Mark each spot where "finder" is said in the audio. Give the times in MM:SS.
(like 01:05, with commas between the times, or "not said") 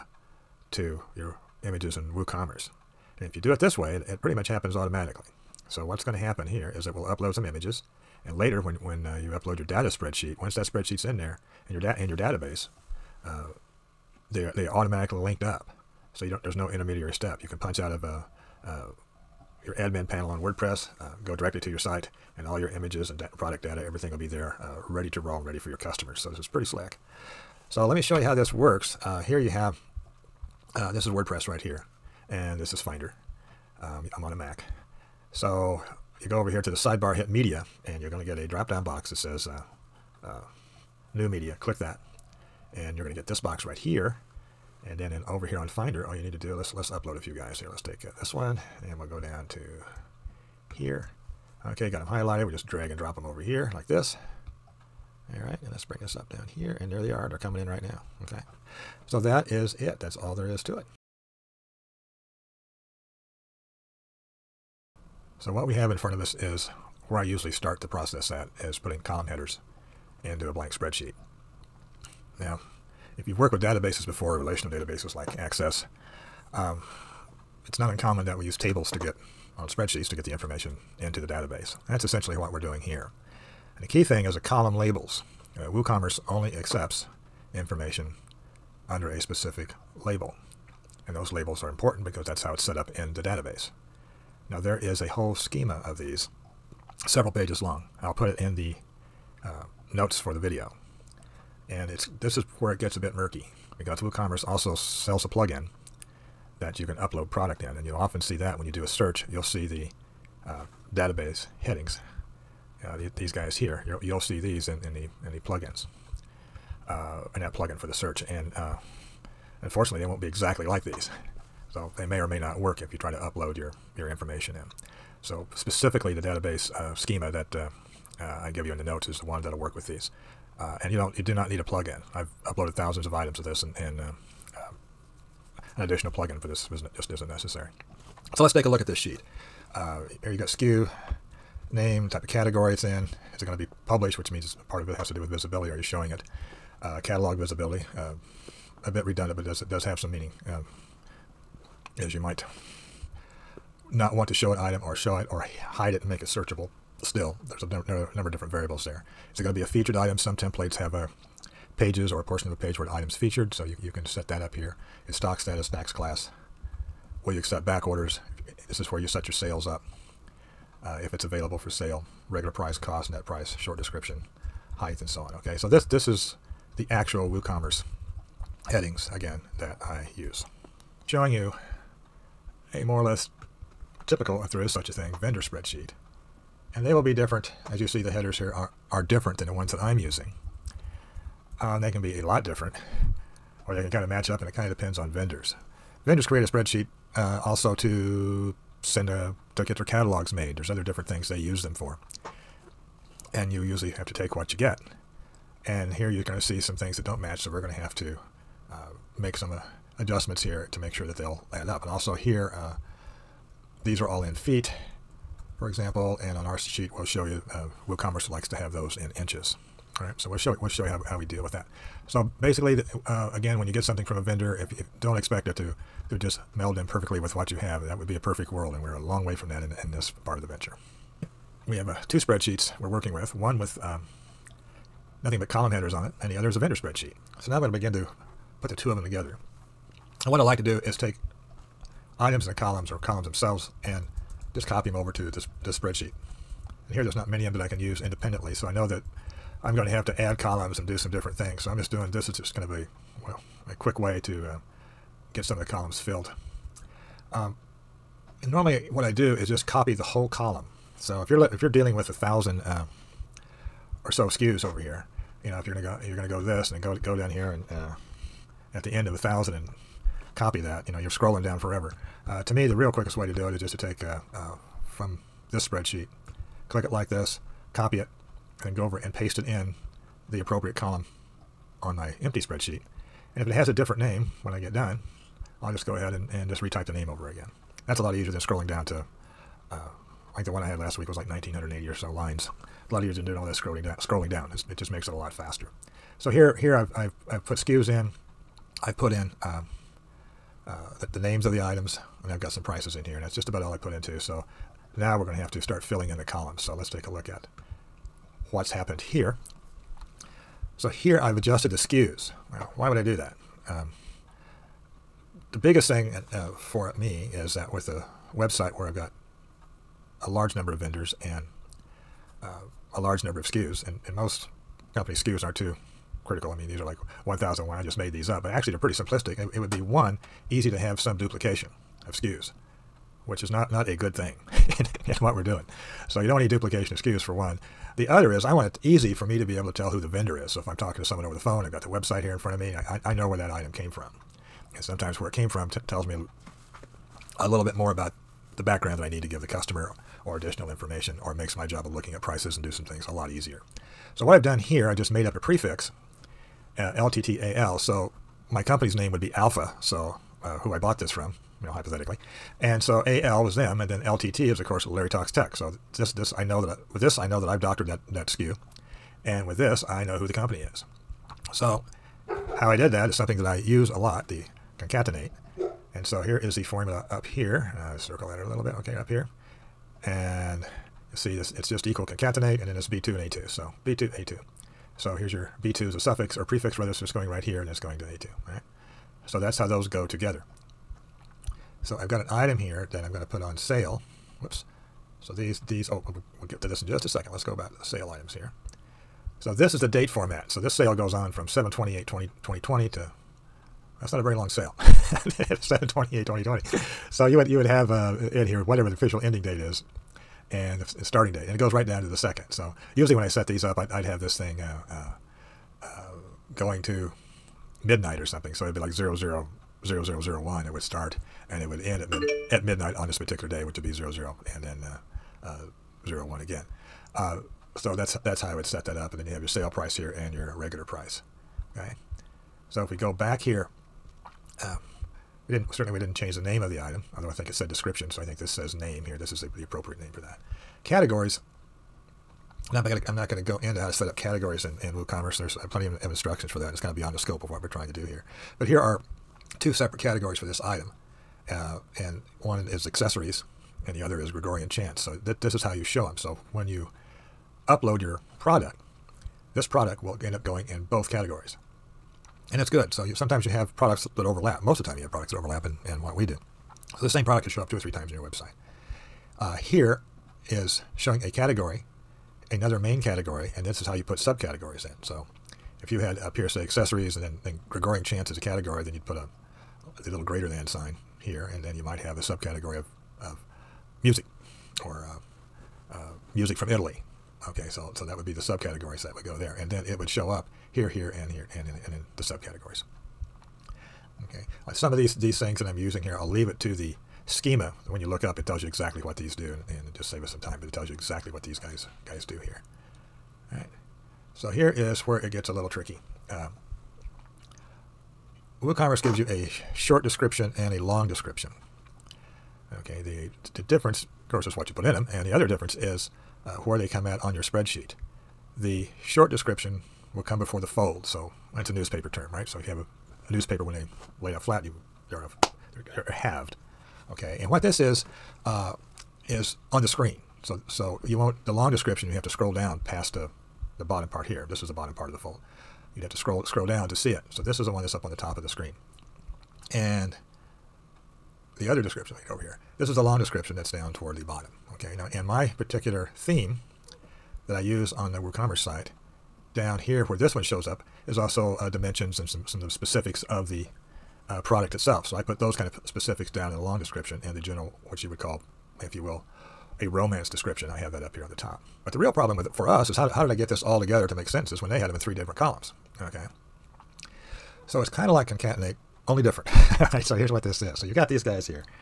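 00:32, 00:45.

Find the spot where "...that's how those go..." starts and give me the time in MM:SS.
06:29.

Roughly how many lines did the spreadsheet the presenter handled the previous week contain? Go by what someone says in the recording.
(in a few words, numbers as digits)
1980.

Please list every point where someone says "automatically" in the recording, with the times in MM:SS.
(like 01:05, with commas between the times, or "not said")
00:04, 00:14.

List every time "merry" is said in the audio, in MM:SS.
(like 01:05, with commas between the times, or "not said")
not said.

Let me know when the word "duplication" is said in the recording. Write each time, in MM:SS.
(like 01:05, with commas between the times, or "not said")
05:31, 05:36.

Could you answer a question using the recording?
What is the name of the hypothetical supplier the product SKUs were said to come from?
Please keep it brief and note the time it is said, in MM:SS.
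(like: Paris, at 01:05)
Alpha, at 05:59.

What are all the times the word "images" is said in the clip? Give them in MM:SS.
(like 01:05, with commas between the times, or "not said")
00:01, 00:07, 00:22.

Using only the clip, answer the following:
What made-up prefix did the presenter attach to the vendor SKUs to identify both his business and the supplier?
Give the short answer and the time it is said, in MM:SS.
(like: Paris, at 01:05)
LTTAL, at 05:56.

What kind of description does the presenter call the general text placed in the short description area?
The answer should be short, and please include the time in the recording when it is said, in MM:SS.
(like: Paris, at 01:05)
romance description, at 09:19.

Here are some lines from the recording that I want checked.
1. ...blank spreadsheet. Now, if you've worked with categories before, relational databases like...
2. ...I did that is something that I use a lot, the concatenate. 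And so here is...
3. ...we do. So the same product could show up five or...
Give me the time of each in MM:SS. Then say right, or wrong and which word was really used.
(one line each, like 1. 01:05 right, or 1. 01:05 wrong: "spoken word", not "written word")
1. 01:10 wrong: "databases", not "categories"
2. 06:12 right
3. 07:46 wrong: "two", not "five".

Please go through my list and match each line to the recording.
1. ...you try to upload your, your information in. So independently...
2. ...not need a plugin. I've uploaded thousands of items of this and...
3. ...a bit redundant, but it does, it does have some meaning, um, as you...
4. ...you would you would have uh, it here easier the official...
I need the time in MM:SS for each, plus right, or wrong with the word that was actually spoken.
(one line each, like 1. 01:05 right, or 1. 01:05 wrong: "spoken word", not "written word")
1. 02:02 wrong: "specifically", not "independently"
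2. 02:11 right
3. 02:28 right
4. 06:47 wrong: "whatever", not "easier".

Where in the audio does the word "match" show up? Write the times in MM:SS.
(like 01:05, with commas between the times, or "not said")
03:14, 03:27.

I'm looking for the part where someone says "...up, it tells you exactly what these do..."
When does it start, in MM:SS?
08:18.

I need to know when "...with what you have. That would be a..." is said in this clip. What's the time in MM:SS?
03:47.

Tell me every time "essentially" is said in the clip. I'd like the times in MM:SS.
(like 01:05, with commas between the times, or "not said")
01:22.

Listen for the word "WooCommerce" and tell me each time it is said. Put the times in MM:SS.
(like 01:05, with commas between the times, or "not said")
00:02, 01:25, 01:43, 02:57, 03:37, 07:24, 08:28, 09:08.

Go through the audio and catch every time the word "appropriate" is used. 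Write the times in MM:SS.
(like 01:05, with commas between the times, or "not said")
04:40, 07:19.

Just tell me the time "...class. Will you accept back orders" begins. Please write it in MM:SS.
02:45.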